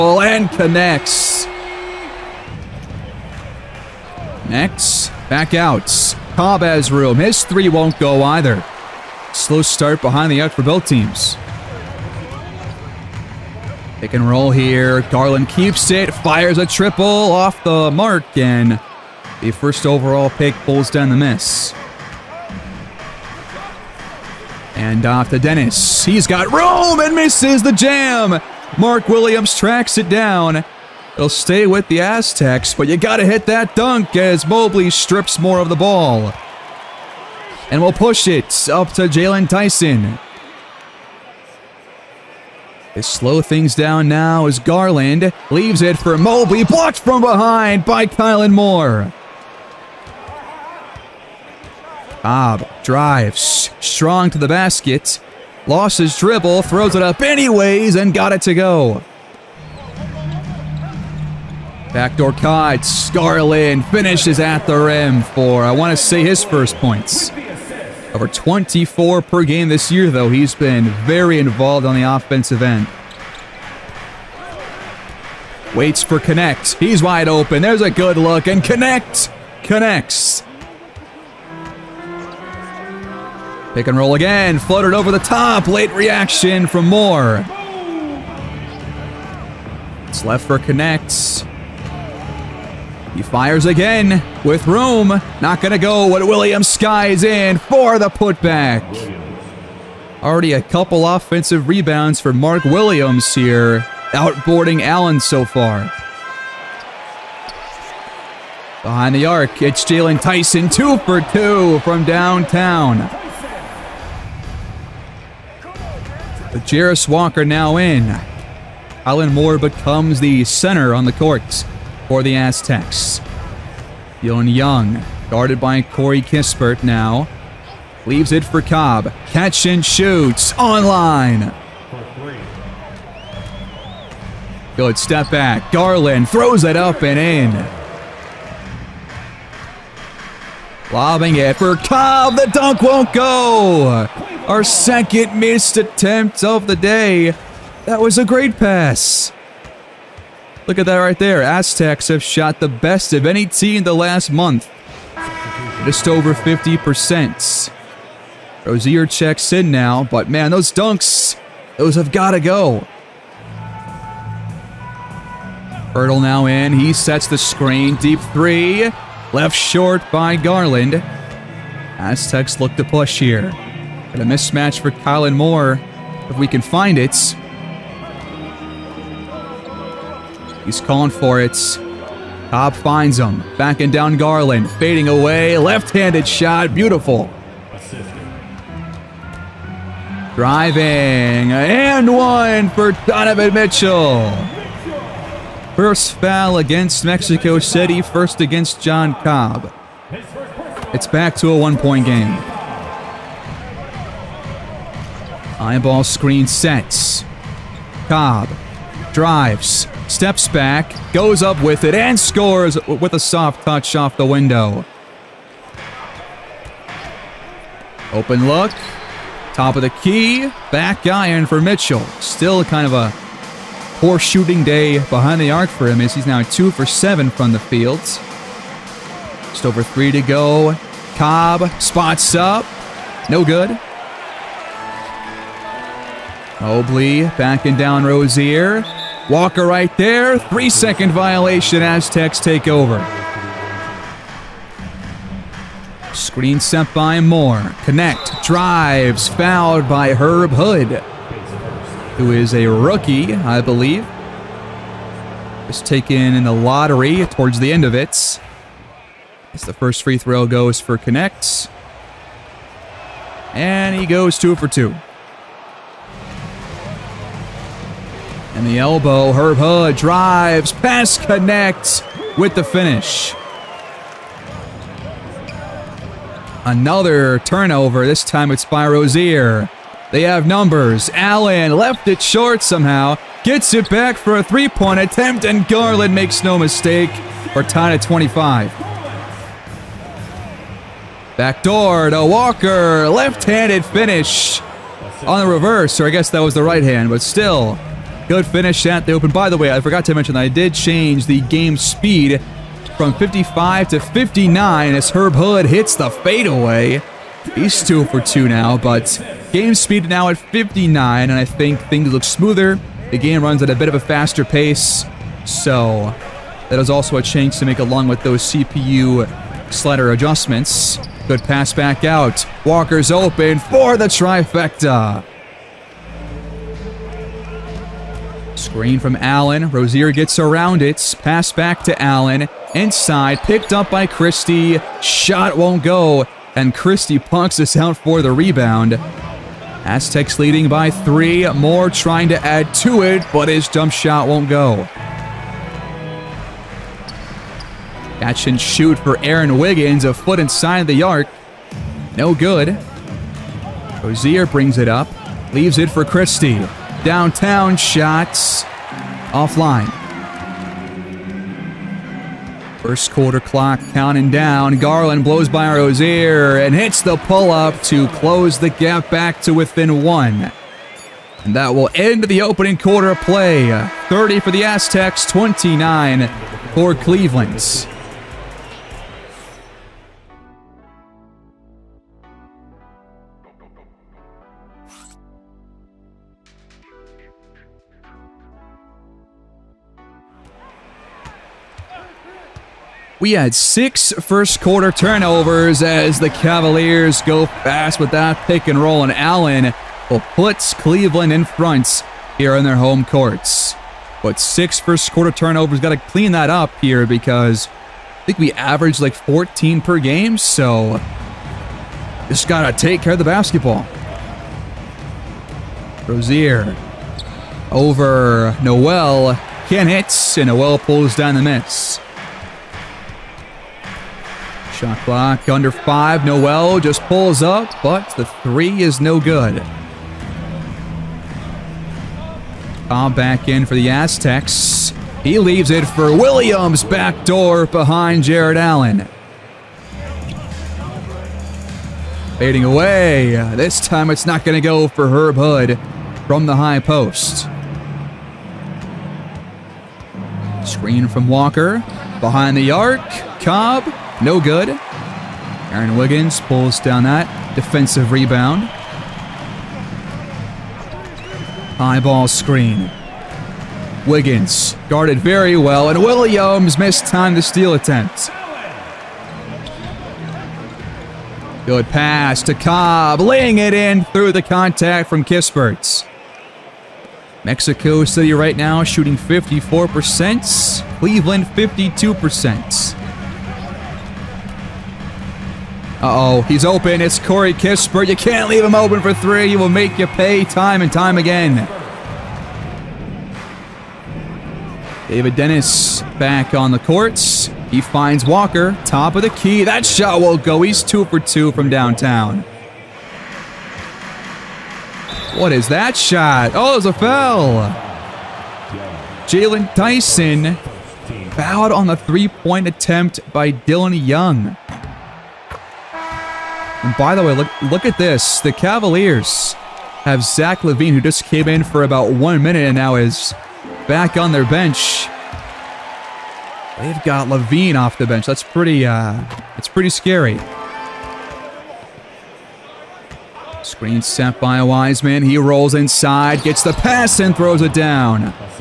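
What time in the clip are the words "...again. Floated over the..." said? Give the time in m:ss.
1:24.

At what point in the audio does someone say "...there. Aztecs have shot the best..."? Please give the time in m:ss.
2:31.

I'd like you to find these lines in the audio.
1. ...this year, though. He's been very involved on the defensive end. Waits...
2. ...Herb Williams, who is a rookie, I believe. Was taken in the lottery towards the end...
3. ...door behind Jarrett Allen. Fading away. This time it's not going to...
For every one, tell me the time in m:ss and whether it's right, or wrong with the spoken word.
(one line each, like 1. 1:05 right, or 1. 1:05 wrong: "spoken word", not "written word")
1. 1:09 wrong: "offensive", not "defensive"
2. 4:10 wrong: "Hood", not "Williams"
3. 7:17 right.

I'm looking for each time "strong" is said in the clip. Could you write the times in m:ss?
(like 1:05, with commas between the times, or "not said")
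0:53.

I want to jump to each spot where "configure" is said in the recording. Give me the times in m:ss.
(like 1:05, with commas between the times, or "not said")
not said.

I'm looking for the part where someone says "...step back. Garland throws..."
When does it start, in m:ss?
2:14.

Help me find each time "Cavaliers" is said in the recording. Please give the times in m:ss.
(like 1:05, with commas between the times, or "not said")
6:36, 8:38.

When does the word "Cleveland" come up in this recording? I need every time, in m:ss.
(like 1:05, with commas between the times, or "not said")
6:16, 6:40, 8:00.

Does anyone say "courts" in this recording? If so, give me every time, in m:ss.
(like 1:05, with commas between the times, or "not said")
2:01, 6:43, 8:16.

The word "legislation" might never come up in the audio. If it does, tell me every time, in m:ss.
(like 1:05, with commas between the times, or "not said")
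not said.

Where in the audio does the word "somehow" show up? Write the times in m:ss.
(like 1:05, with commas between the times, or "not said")
4:42.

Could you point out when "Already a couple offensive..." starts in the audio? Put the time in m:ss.
1:40.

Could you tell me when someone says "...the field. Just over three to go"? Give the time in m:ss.
3:47.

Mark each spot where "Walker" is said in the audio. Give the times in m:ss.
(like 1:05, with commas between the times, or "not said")
1:57, 3:59, 4:52, 5:22, 7:31, 8:18.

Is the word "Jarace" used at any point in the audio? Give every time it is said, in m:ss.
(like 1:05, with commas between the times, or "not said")
1:56.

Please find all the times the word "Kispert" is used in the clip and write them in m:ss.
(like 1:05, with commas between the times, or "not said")
2:06, 7:55, 8:07.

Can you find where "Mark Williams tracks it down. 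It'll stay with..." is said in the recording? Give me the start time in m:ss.
0:28.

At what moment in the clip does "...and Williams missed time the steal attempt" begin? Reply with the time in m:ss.
7:45.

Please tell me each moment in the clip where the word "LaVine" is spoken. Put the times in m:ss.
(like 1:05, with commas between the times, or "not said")
8:40, 8:47.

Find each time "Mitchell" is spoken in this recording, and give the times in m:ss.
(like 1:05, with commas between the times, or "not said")
3:13, 3:41.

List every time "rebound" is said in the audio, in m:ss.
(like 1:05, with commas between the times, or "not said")
1:41, 5:38, 7:38.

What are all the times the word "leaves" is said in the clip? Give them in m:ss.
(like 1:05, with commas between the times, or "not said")
0:45, 2:08, 5:55, 7:15, 8:08.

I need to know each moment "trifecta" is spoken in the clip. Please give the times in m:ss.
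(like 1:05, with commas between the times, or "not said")
5:24.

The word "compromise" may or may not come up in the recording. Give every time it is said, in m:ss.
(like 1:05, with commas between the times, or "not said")
not said.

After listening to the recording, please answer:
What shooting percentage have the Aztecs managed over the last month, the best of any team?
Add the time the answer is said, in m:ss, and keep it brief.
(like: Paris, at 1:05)
Just over 50%, at 2:35.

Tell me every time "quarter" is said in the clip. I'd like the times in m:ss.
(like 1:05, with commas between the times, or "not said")
6:03, 6:12, 6:34, 6:45.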